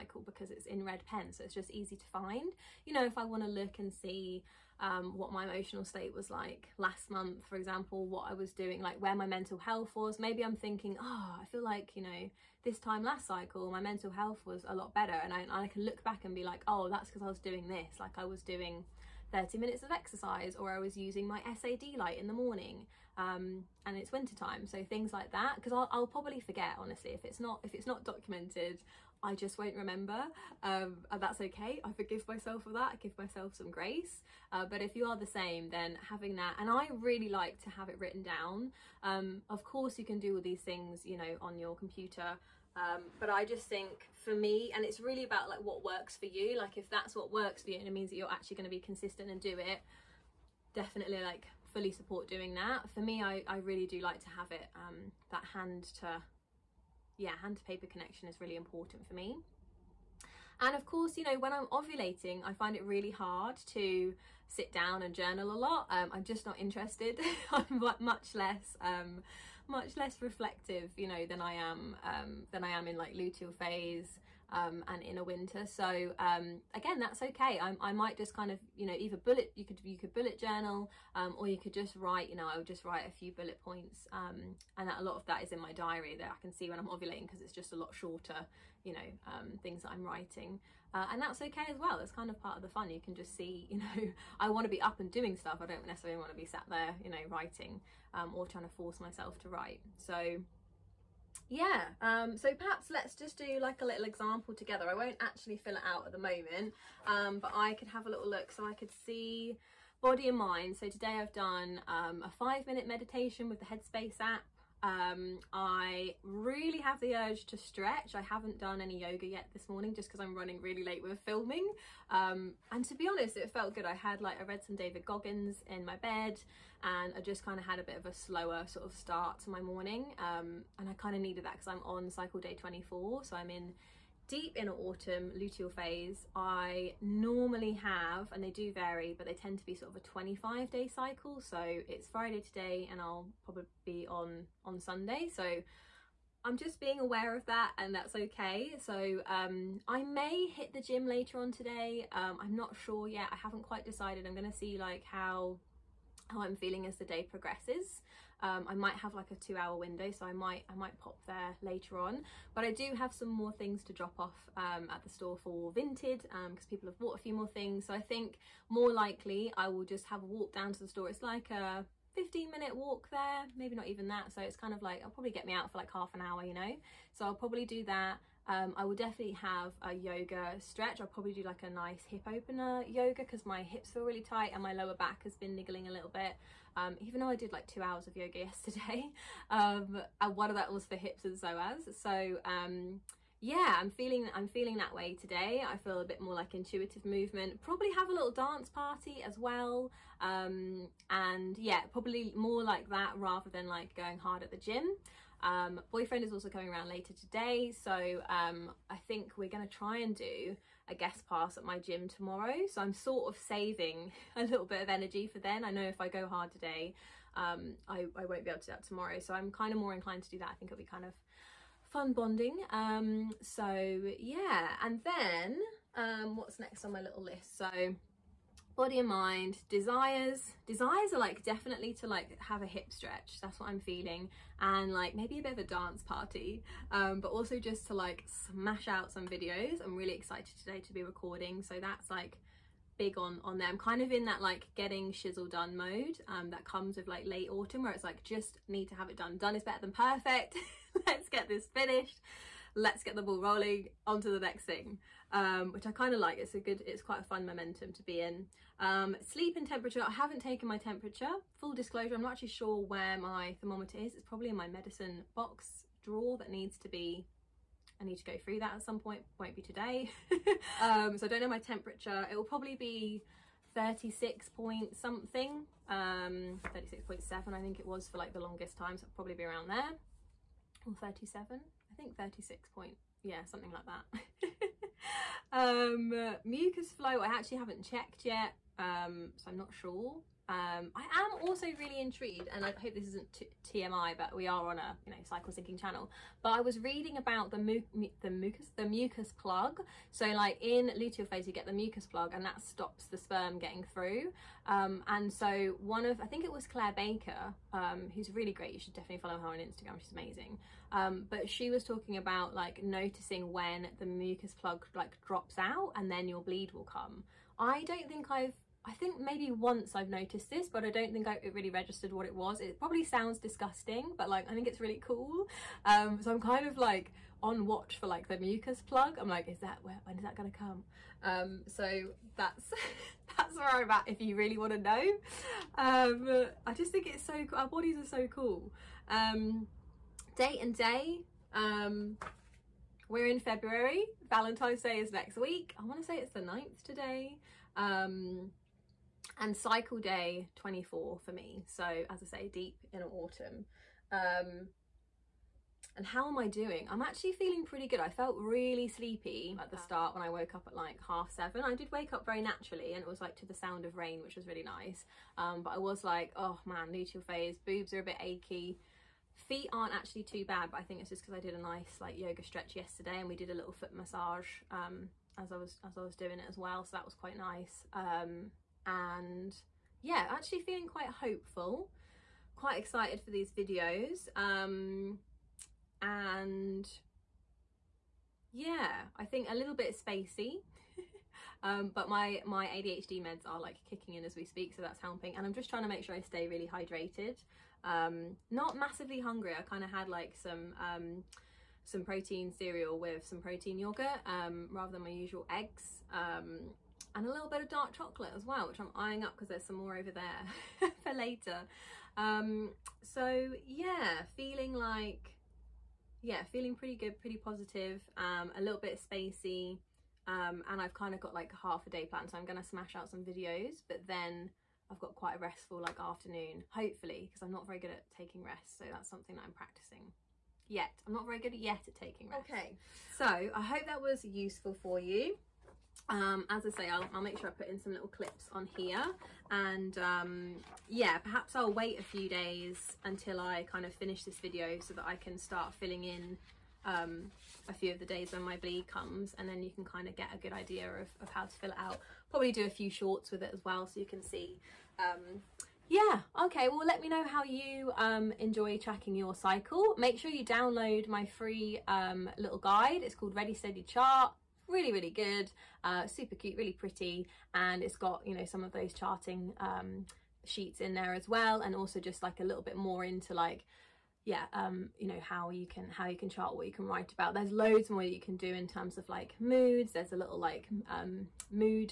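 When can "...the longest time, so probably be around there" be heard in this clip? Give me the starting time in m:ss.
4:38.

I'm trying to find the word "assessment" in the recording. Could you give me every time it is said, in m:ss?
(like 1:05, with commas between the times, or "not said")
not said.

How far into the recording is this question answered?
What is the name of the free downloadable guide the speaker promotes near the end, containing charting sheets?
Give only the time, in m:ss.
7:43.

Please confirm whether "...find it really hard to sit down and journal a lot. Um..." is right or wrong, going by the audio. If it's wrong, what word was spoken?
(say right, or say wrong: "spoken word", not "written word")
right.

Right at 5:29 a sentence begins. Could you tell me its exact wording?
I'm like, is that where, when is that going to come?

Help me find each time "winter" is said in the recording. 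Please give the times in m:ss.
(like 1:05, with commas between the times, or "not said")
0:24, 1:15.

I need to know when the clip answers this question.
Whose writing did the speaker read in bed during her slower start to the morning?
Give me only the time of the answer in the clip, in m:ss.
2:04.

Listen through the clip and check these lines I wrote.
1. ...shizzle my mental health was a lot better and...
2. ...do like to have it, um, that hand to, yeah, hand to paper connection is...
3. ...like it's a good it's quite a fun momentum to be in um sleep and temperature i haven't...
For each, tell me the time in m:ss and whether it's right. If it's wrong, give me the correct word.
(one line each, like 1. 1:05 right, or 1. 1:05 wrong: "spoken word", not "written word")
1. 0:13 wrong: "cycle", not "shizzle"
2. 0:53 right
3. 4:16 right.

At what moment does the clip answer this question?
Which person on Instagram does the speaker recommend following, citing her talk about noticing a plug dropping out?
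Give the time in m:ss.
5:06.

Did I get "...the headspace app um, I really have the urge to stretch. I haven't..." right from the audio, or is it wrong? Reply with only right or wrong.
right.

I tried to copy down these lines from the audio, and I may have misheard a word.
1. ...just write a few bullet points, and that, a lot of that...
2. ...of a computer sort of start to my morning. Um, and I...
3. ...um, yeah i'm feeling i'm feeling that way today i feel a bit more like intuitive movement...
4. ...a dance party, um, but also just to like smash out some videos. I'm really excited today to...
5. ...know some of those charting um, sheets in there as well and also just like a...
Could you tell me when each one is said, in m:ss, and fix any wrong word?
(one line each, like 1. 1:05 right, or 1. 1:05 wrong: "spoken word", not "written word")
1. 1:22 right
2. 2:07 wrong: "slower", not "computer"
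3. 3:12 right
4. 3:55 right
5. 7:48 right.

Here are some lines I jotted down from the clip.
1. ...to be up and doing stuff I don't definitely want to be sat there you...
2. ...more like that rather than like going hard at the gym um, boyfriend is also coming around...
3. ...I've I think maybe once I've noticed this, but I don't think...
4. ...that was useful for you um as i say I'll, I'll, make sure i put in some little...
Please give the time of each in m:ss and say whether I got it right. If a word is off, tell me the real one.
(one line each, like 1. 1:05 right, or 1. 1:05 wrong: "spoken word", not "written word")
1. 1:34 wrong: "necessarily", not "definitely"
2. 3:22 right
3. 5:18 right
4. 7:13 right.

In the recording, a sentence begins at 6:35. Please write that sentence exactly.
And I'm just trying to make sure I stay really hydrated.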